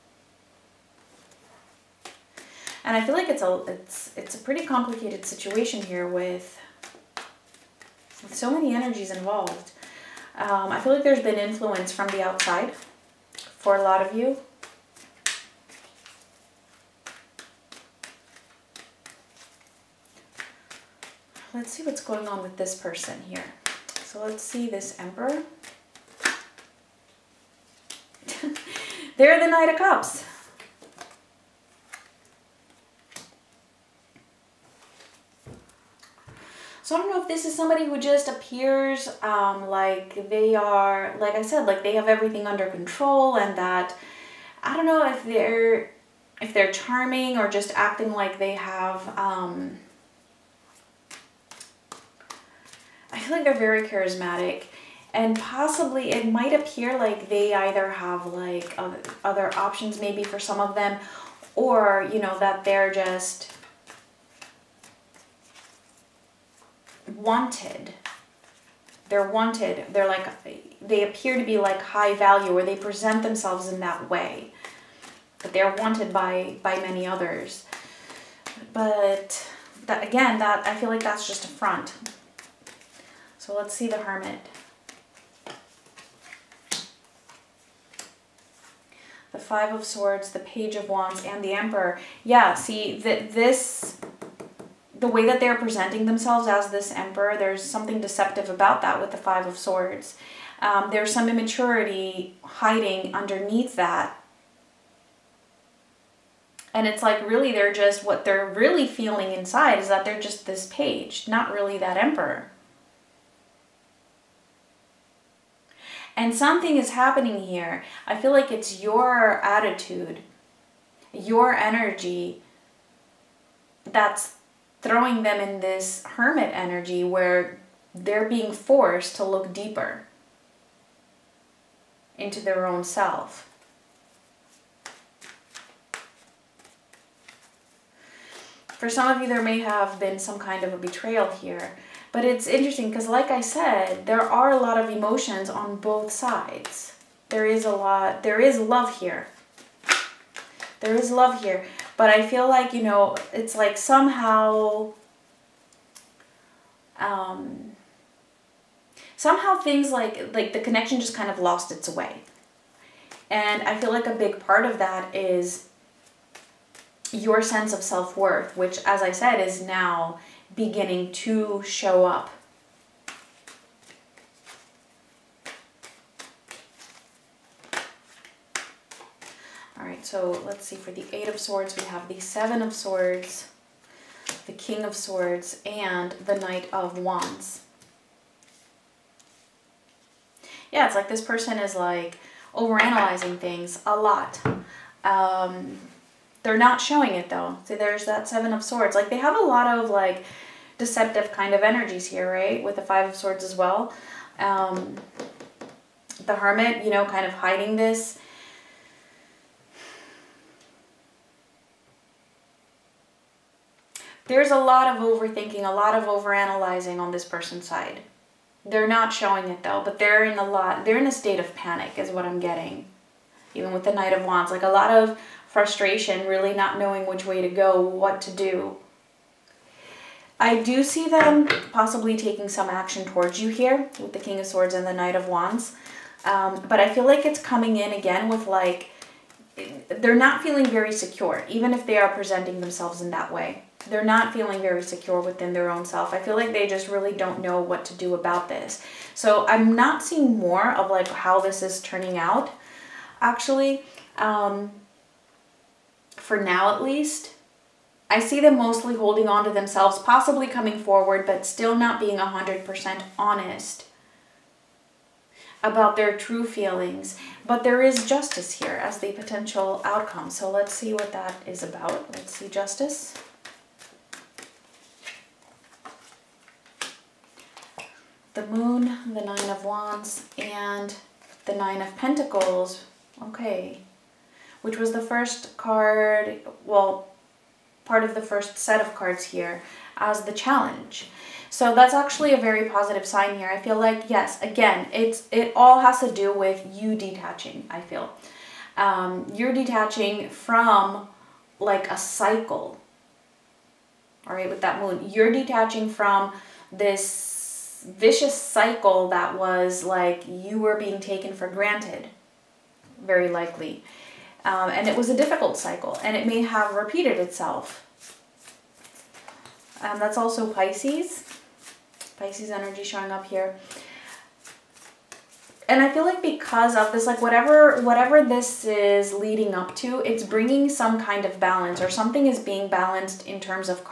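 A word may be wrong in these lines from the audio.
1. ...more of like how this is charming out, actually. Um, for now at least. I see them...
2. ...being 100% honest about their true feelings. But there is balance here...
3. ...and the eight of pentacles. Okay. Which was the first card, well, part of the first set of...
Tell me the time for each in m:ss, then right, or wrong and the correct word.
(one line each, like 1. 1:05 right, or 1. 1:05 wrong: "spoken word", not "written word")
1. 4:10 wrong: "turning", not "charming"
2. 4:21 wrong: "justice", not "balance"
3. 4:40 wrong: "nine", not "eight".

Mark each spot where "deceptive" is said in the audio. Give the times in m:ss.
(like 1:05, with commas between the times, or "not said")
1:38, 3:20.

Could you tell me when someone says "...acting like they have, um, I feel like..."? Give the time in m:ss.
0:47.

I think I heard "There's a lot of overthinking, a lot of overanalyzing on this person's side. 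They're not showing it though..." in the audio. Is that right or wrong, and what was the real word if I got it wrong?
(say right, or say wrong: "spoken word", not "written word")
right.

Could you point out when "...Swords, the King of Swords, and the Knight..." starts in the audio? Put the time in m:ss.
3:02.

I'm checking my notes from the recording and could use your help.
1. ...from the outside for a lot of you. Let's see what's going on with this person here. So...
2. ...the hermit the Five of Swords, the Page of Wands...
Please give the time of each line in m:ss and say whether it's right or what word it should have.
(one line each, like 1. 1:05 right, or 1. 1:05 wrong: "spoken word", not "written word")
1. 0:11 right
2. 1:23 right.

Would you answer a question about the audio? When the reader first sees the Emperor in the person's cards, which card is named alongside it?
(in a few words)
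Knight of Cups.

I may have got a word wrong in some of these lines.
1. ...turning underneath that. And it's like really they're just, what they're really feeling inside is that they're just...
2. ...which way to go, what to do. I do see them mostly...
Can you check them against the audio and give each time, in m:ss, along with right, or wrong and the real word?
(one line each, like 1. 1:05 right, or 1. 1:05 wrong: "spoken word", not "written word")
1. 1:42 wrong: "hiding", not "turning"
2. 3:47 wrong: "possibly", not "mostly".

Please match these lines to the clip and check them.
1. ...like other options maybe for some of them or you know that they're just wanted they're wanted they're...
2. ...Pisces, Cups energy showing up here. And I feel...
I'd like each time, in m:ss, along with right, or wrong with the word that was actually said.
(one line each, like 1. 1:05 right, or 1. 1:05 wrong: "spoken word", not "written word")
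1. 0:58 right
2. 5:20 wrong: "Pisces", not "Cups".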